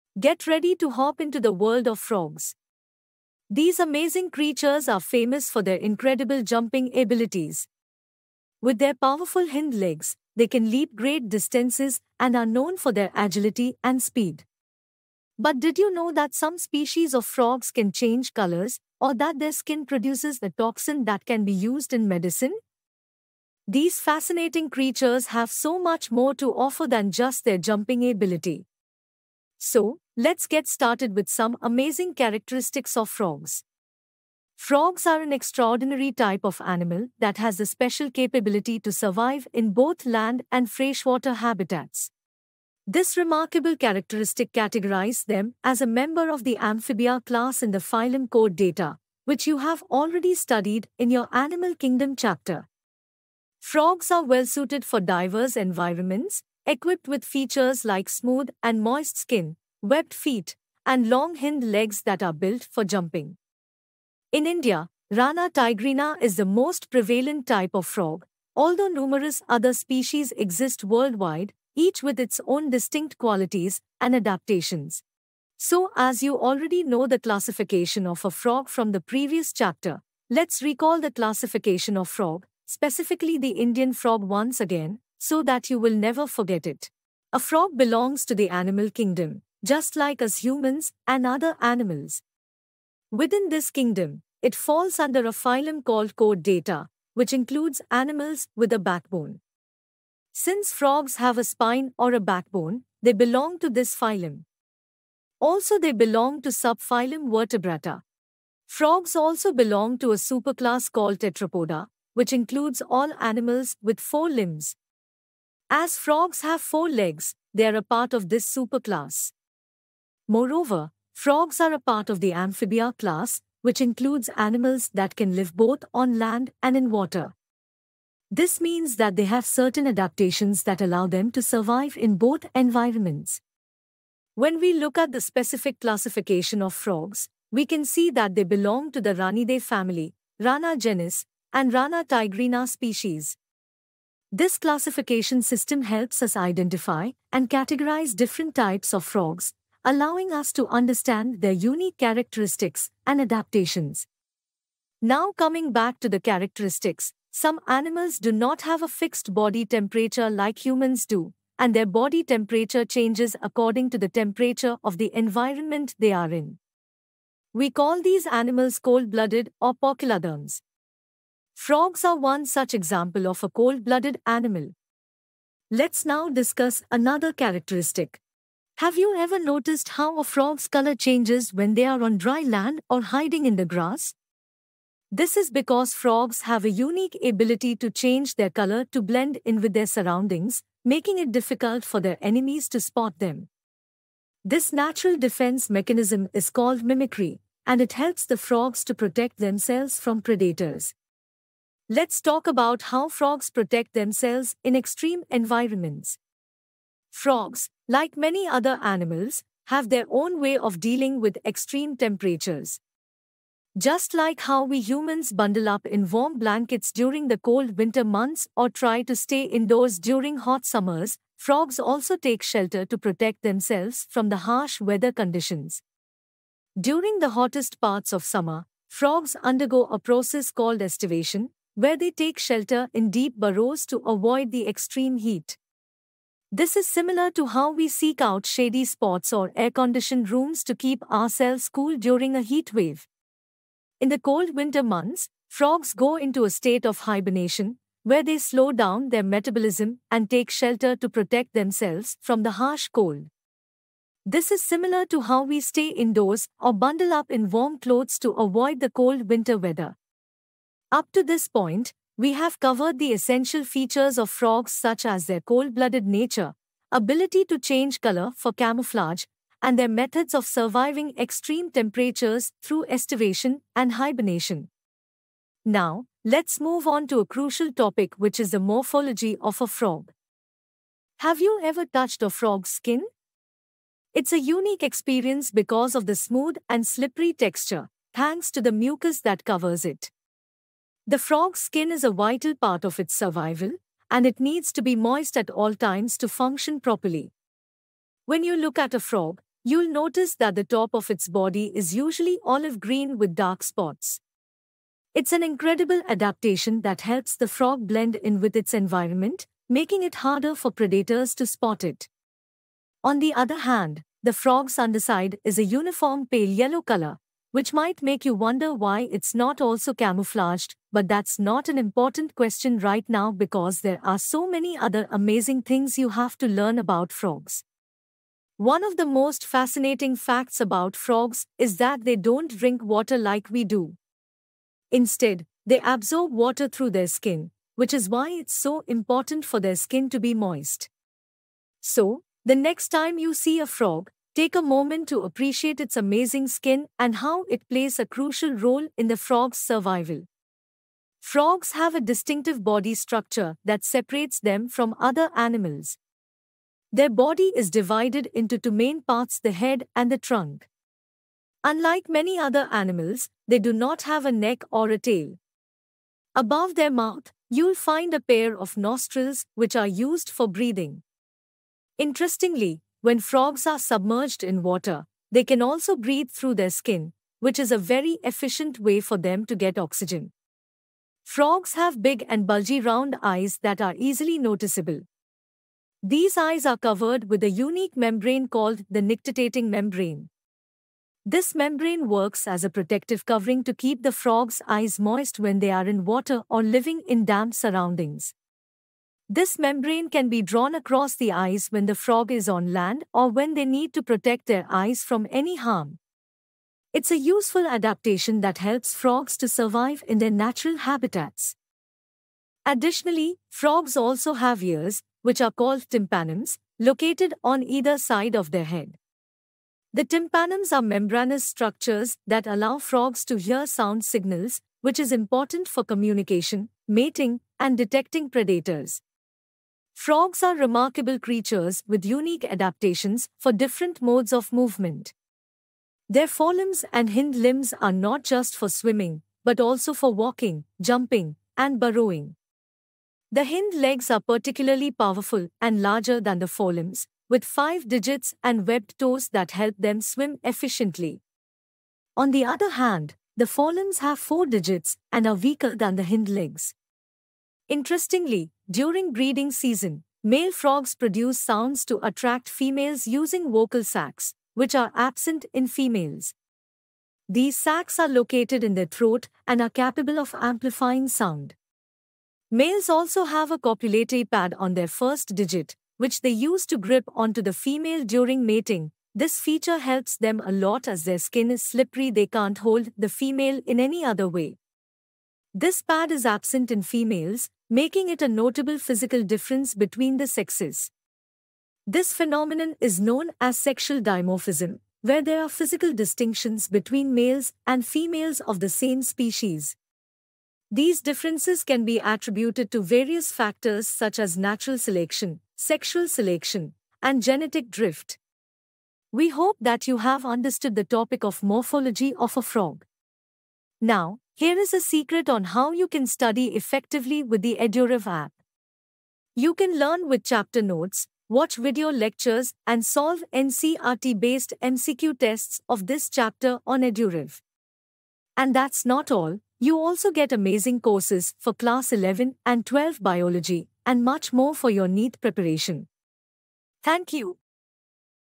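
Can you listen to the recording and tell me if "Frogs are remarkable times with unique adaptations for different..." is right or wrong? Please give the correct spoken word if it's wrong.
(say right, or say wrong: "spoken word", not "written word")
wrong: "creatures", not "times".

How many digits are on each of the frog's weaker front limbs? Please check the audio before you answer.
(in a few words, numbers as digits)
4.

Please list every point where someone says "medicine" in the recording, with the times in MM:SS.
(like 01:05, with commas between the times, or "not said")
00:22.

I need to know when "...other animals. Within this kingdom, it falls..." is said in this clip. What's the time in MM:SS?
01:31.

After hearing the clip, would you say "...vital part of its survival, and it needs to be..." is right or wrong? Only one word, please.
right.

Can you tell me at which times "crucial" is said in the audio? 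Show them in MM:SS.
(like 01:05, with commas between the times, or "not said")
04:37, 05:48.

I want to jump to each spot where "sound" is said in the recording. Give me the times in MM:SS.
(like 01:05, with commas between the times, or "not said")
07:03, 07:41, 07:51.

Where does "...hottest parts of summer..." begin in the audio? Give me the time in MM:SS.
03:47.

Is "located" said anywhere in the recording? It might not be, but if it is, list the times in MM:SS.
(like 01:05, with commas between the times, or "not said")
06:56, 07:48.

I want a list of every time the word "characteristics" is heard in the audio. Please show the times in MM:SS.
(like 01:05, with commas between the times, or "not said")
00:32, 00:43, 02:31, 02:36, 02:57.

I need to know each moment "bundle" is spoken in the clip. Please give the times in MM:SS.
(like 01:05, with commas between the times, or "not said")
03:35, 04:16.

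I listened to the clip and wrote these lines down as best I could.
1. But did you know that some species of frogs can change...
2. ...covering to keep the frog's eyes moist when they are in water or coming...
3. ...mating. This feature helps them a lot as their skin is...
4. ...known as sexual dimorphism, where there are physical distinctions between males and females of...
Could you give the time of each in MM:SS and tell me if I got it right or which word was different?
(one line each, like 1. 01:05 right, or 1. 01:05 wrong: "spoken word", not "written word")
1. 00:15 right
2. 06:33 wrong: "living", not "coming"
3. 07:58 right
4. 08:12 right.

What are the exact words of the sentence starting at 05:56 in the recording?
Their body is divided into two main parts the head and the trunk.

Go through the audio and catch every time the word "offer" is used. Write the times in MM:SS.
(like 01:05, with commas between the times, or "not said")
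00:26.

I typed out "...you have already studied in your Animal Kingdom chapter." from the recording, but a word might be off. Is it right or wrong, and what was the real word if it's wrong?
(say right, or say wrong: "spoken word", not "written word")
right.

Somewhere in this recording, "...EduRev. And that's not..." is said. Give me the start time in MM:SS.
08:46.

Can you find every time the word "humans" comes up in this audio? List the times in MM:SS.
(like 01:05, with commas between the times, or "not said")
01:30, 02:40, 03:34.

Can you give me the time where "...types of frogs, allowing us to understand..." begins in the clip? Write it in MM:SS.
02:28.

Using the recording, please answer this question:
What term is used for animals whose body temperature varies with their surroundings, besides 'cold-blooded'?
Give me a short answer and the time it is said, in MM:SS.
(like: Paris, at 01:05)
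Poikilotherms, at 02:49.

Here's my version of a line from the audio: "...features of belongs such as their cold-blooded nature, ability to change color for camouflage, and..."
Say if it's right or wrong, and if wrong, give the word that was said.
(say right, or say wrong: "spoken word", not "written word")
wrong: "frogs", not "belongs".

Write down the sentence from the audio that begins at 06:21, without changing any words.
Frogs have big and bulgy round eyes that are easily noticeable.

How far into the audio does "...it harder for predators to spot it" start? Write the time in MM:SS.
05:10.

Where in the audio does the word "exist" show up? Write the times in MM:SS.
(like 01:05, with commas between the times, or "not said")
01:10.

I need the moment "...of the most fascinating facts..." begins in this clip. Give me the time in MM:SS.
05:28.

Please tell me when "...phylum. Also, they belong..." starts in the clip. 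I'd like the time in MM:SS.
01:43.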